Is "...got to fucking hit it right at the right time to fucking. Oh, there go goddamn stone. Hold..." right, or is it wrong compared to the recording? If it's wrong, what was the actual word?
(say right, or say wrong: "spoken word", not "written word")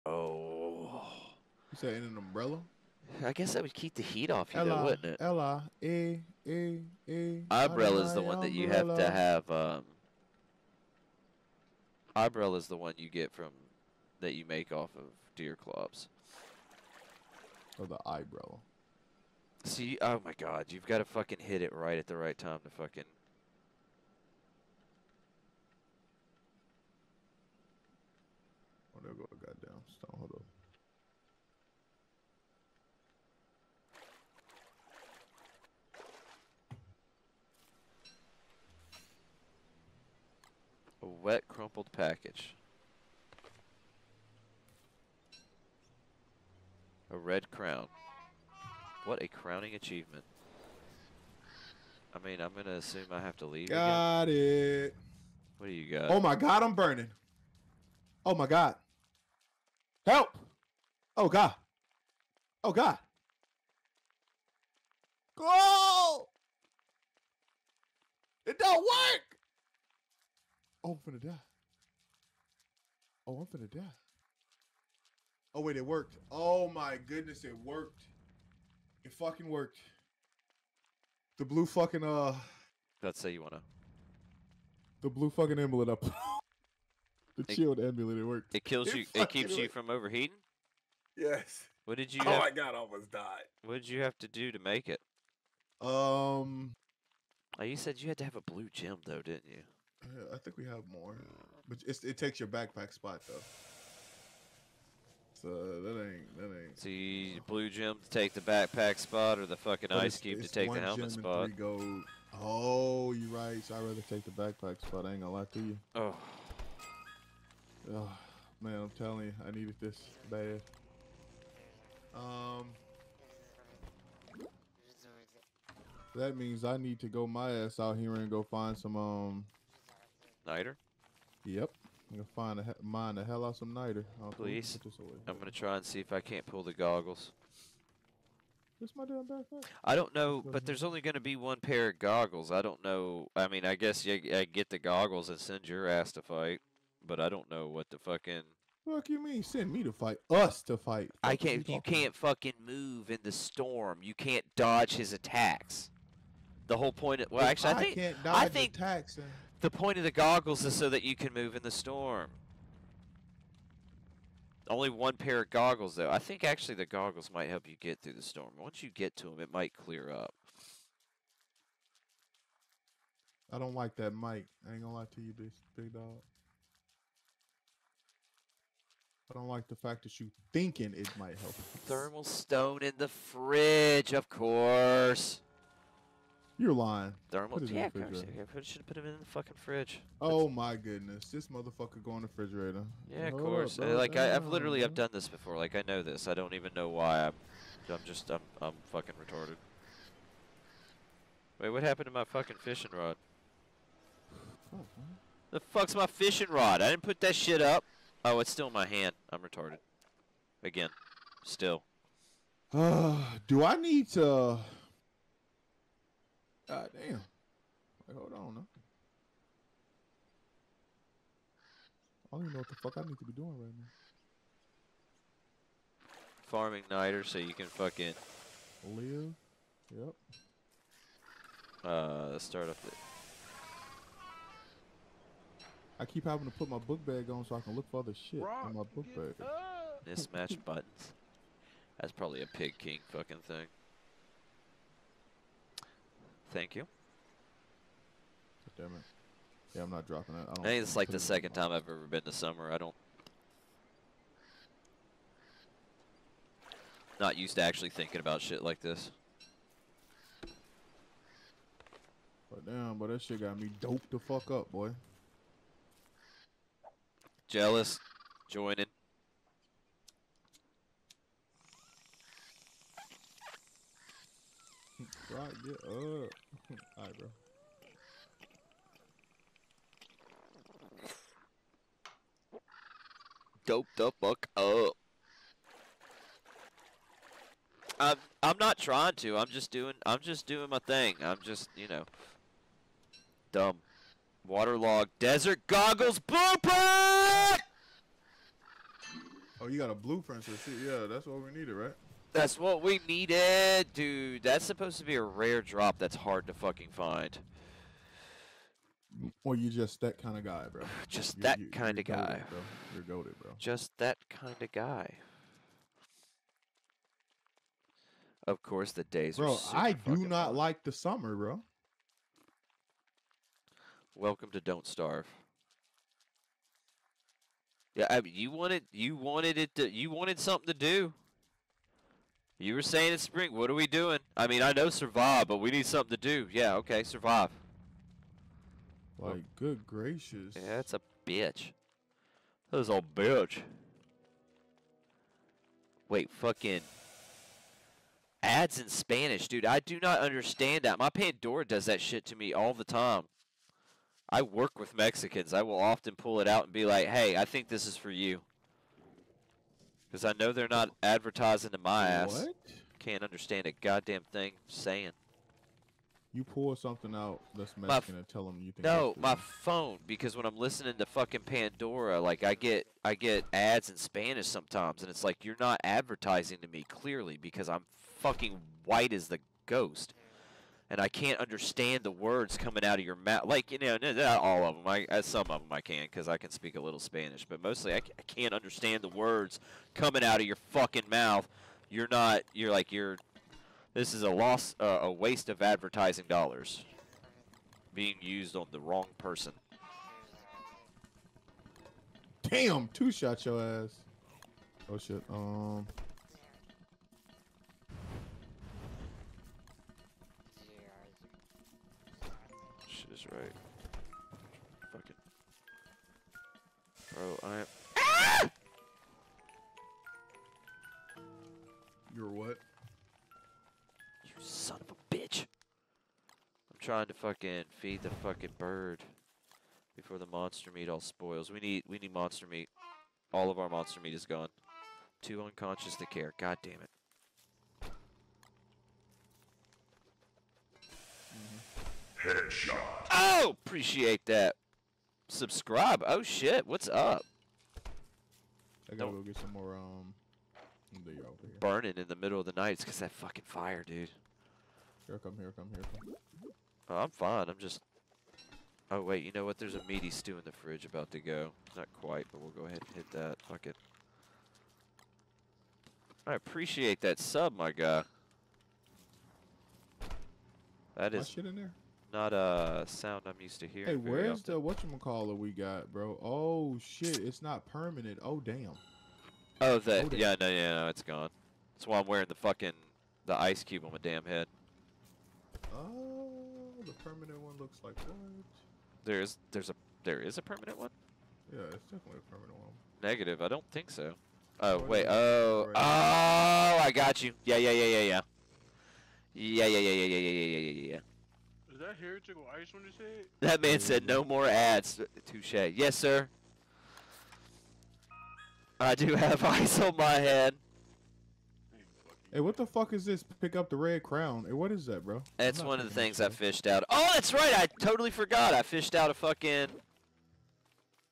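right.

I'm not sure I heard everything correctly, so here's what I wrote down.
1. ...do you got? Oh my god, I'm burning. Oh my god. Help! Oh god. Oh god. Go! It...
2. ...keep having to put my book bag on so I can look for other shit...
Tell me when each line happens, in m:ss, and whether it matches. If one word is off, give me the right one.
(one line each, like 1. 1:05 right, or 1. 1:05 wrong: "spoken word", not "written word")
1. 0:55 right
2. 3:56 right.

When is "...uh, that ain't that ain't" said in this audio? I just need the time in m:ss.
1:45.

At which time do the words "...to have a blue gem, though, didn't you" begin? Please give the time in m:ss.
1:38.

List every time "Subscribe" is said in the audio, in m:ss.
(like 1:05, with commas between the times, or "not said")
7:25.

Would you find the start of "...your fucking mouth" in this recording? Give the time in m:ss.
6:30.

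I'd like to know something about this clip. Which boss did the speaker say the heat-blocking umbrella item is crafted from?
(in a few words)
Deerclops.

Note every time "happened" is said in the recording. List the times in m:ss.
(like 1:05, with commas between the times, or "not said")
3:21.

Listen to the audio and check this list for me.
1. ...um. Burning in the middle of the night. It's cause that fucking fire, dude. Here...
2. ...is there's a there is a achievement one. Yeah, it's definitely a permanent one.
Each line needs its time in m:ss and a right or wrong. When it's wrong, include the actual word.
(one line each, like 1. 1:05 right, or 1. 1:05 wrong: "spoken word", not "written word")
1. 7:29 right
2. 8:09 wrong: "permanent", not "achievement".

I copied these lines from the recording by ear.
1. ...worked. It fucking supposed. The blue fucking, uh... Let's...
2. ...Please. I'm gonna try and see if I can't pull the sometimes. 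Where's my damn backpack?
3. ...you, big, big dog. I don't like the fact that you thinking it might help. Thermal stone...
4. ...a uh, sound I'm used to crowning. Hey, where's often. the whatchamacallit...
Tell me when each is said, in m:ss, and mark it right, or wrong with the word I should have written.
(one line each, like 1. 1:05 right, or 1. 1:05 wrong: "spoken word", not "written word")
1. 1:17 wrong: "worked", not "supposed"
2. 2:14 wrong: "goggles", not "sometimes"
3. 2:55 right
4. 7:52 wrong: "hearing", not "crowning".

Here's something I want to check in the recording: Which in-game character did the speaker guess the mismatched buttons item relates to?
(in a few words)
Pig King.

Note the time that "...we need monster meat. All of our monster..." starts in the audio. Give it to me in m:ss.
7:11.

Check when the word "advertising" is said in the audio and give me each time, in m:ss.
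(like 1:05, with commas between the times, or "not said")
6:01, 6:15, 6:35.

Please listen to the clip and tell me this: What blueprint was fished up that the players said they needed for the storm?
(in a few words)
desert goggles.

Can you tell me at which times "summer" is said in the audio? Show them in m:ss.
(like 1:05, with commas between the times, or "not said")
4:12, 5:20.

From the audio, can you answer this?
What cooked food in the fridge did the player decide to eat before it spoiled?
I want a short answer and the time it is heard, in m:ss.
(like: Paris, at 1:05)
meaty stew, at 7:39.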